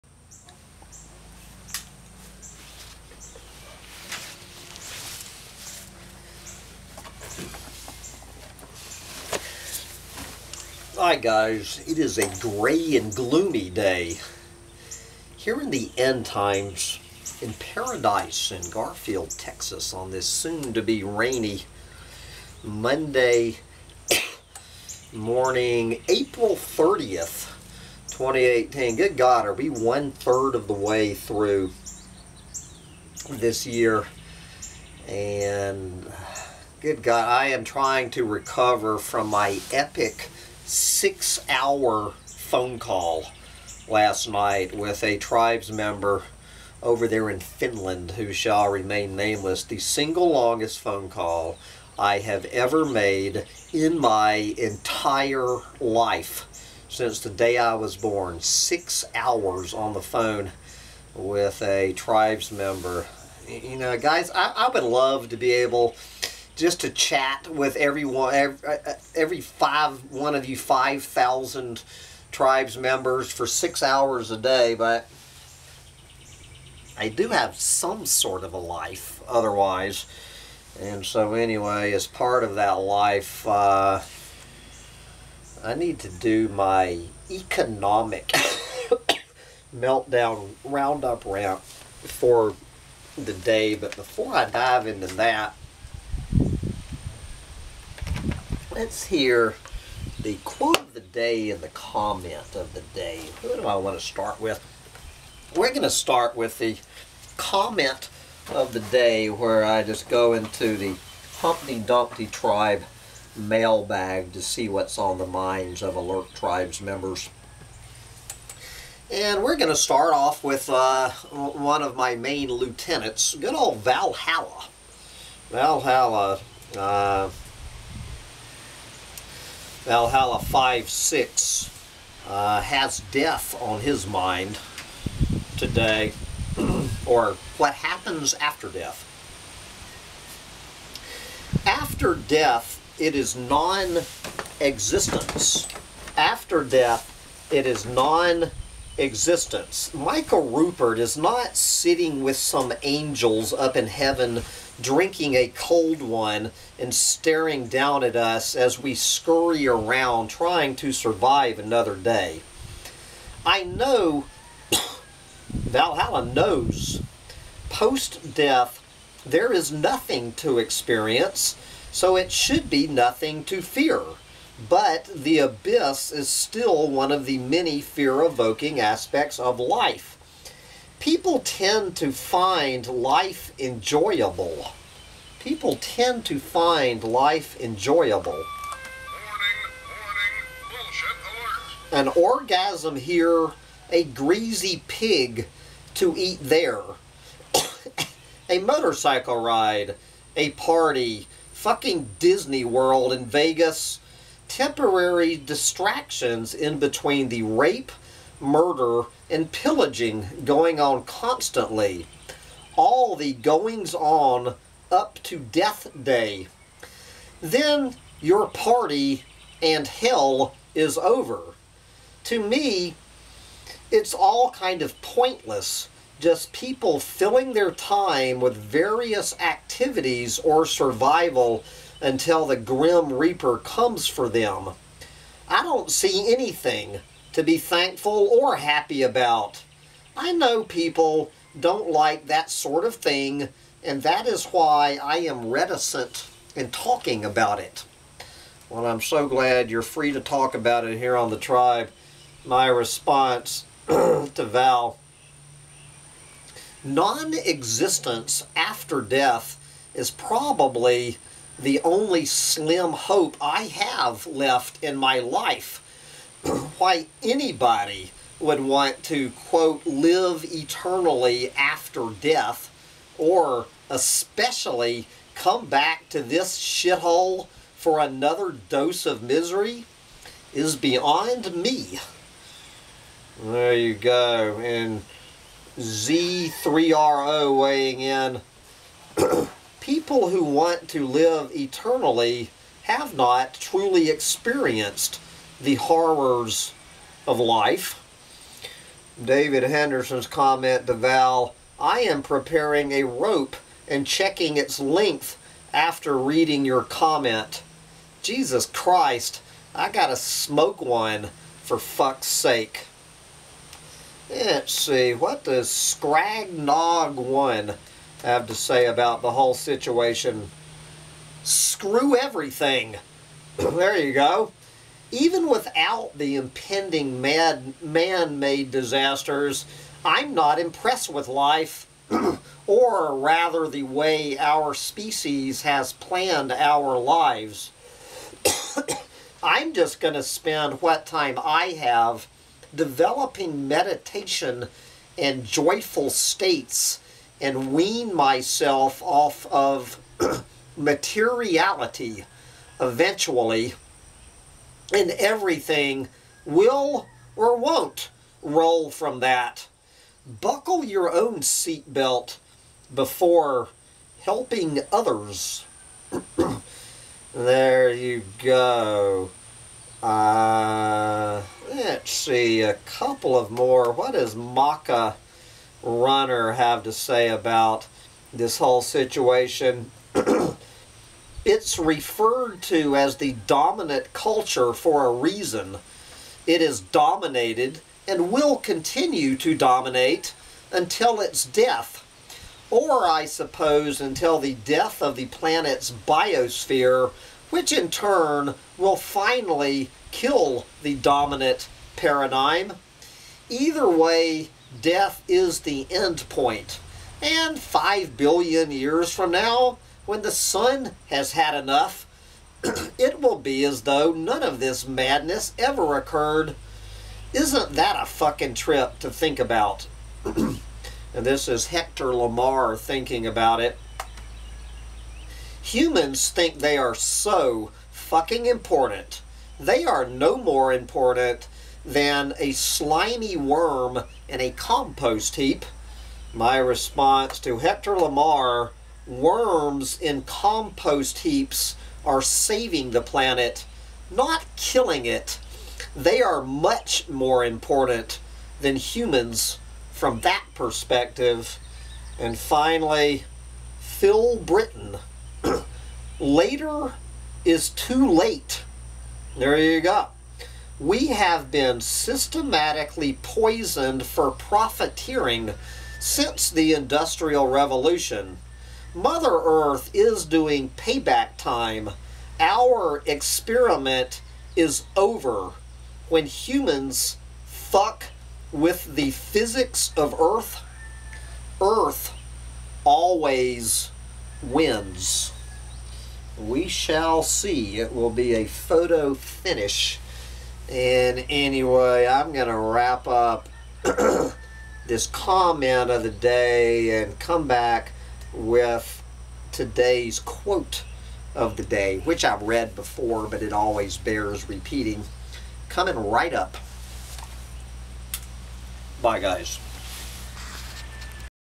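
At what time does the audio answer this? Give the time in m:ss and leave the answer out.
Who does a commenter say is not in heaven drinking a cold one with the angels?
2:29.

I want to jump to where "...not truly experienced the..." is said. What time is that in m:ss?
4:53.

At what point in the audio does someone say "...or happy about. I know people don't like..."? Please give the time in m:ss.
3:58.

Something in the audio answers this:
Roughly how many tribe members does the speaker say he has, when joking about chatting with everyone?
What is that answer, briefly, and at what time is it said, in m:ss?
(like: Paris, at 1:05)
5,000, at 1:10.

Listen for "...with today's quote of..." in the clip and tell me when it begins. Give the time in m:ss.
8:18.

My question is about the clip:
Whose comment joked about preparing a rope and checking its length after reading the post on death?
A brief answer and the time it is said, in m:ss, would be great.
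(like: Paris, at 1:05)
David Henderson, at 4:59.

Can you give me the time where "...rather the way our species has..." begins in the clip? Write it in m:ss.
5:33.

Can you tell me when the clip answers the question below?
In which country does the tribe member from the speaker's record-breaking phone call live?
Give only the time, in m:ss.
0:47.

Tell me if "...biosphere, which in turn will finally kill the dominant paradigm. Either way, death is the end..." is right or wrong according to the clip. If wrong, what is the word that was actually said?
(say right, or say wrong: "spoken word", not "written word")
right.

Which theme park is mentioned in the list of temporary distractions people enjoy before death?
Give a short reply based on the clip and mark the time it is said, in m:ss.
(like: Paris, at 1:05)
Disney World, at 3:22.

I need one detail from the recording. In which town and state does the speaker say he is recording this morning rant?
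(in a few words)
Garfield, Texas.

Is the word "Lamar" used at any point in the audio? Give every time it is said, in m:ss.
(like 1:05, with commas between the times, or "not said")
7:02, 7:17.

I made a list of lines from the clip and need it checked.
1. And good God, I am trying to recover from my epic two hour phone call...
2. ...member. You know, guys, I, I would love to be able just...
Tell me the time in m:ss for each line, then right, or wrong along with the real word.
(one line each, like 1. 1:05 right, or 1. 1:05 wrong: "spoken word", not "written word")
1. 0:35 wrong: "six", not "two"
2. 1:02 right.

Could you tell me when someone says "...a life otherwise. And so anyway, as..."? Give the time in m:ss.
1:18.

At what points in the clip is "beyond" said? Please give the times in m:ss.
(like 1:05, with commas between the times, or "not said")
4:40.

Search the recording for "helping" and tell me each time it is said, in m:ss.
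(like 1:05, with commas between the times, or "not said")
6:04.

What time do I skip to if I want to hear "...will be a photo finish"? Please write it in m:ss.
8:07.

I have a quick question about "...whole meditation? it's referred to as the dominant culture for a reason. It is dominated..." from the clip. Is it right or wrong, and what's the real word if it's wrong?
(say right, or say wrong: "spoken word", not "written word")
wrong: "situation", not "meditation".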